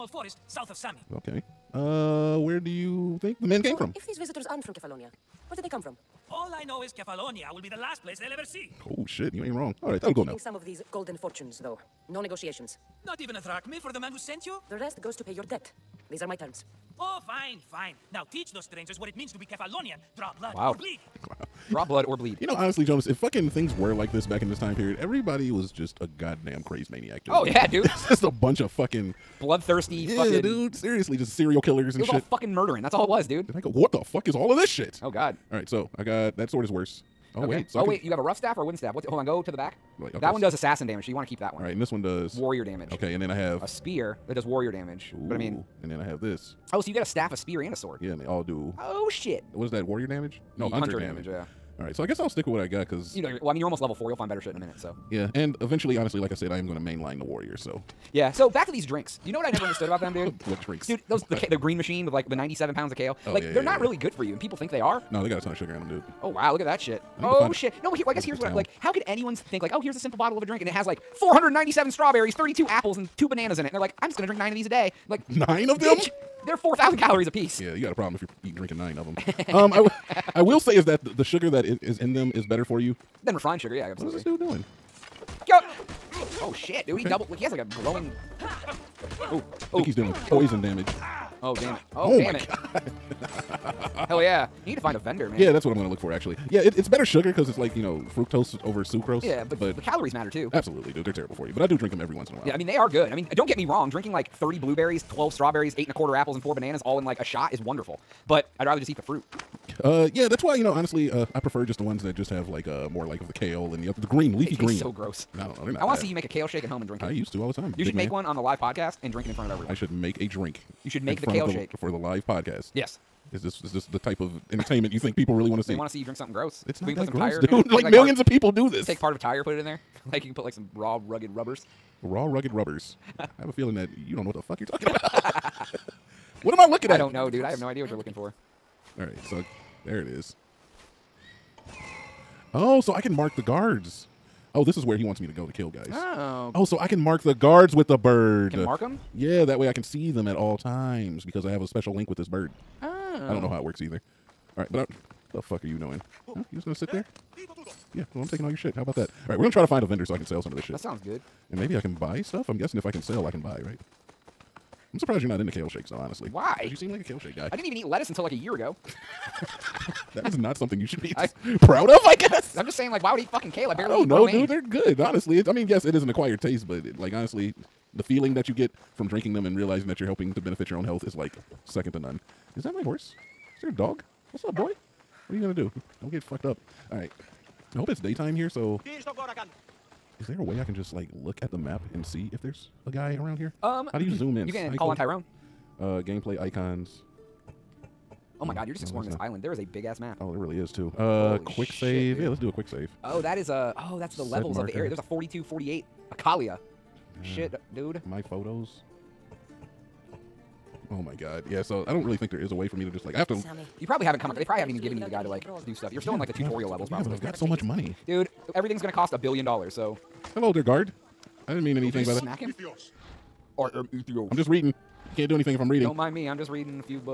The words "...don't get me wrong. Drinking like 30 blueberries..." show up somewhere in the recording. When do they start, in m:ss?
1:43.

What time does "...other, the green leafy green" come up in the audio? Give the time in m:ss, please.
1:53.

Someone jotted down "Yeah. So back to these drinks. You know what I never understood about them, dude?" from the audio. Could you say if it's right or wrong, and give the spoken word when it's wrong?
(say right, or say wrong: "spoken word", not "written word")
right.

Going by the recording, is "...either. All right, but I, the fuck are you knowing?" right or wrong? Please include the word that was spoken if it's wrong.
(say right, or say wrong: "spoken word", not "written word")
right.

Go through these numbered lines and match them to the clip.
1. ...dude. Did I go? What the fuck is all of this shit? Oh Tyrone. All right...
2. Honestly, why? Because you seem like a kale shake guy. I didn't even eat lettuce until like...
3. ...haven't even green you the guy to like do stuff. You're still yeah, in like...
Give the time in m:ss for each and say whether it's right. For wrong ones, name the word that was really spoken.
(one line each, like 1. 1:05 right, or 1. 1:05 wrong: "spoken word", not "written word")
1. 0:33 wrong: "God", not "Tyrone"
2. 2:45 right
3. 3:34 wrong: "given", not "green".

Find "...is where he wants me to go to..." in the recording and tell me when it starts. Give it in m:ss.
2:24.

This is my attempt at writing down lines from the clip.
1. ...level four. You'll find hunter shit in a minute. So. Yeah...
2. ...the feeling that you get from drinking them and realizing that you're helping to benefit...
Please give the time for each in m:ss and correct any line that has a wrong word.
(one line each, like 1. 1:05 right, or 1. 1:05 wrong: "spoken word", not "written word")
1. 0:53 wrong: "better", not "hunter"
2. 2:57 right.